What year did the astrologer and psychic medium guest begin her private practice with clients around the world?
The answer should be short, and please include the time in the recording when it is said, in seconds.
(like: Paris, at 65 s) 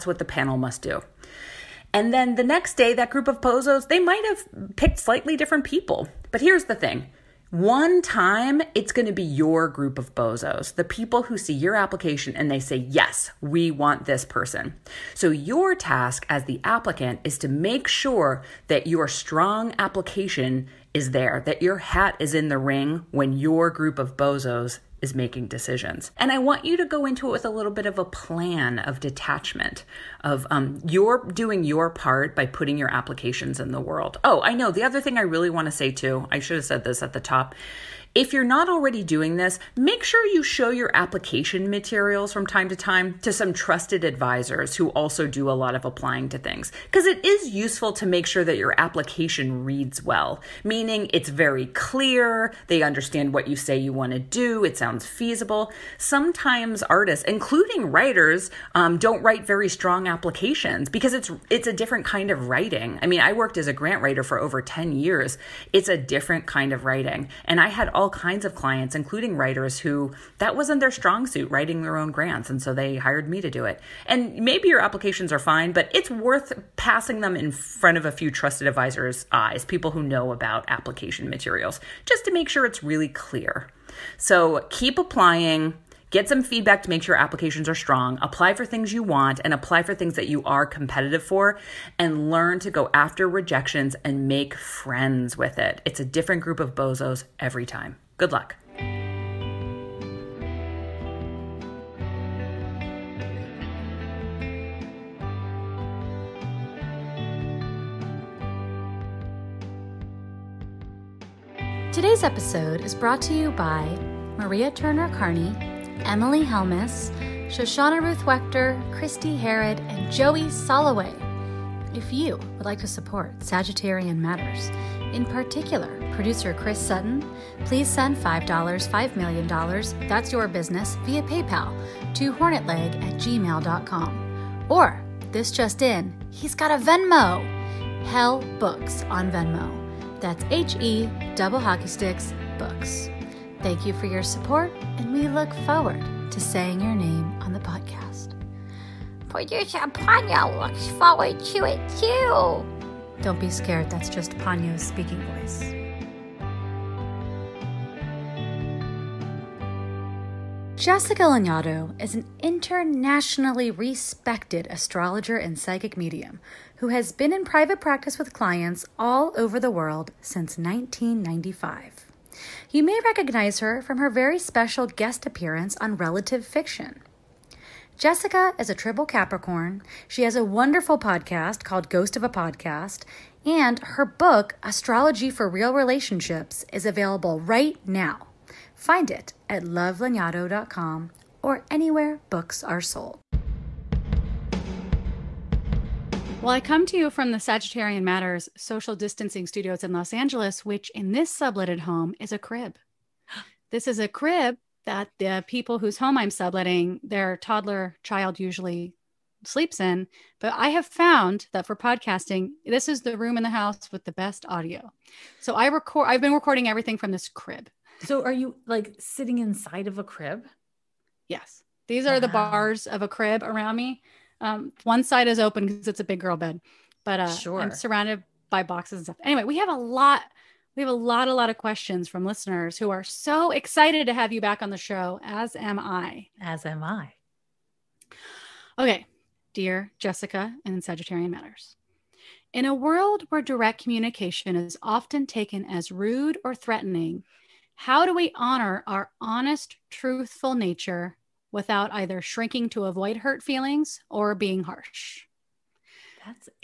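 1995, at 170 s.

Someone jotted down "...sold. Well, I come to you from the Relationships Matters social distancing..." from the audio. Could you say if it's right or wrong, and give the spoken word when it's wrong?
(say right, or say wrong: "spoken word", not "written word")
wrong: "Sagittarian", not "Relationships".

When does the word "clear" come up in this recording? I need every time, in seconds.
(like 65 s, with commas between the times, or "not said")
51 s, 83 s.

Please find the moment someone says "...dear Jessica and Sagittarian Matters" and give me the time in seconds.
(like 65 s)
239 s.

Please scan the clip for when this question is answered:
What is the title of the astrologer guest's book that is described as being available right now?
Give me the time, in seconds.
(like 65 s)
184 s.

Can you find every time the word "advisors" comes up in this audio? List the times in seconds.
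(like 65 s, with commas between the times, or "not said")
44 s, 78 s.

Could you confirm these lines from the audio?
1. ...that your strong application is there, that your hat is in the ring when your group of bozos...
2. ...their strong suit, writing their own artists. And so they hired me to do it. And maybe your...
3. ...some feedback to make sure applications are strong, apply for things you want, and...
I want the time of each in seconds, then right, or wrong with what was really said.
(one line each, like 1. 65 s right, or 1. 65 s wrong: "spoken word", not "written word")
1. 18 s right
2. 70 s wrong: "grants", not "artists"
3. 86 s right.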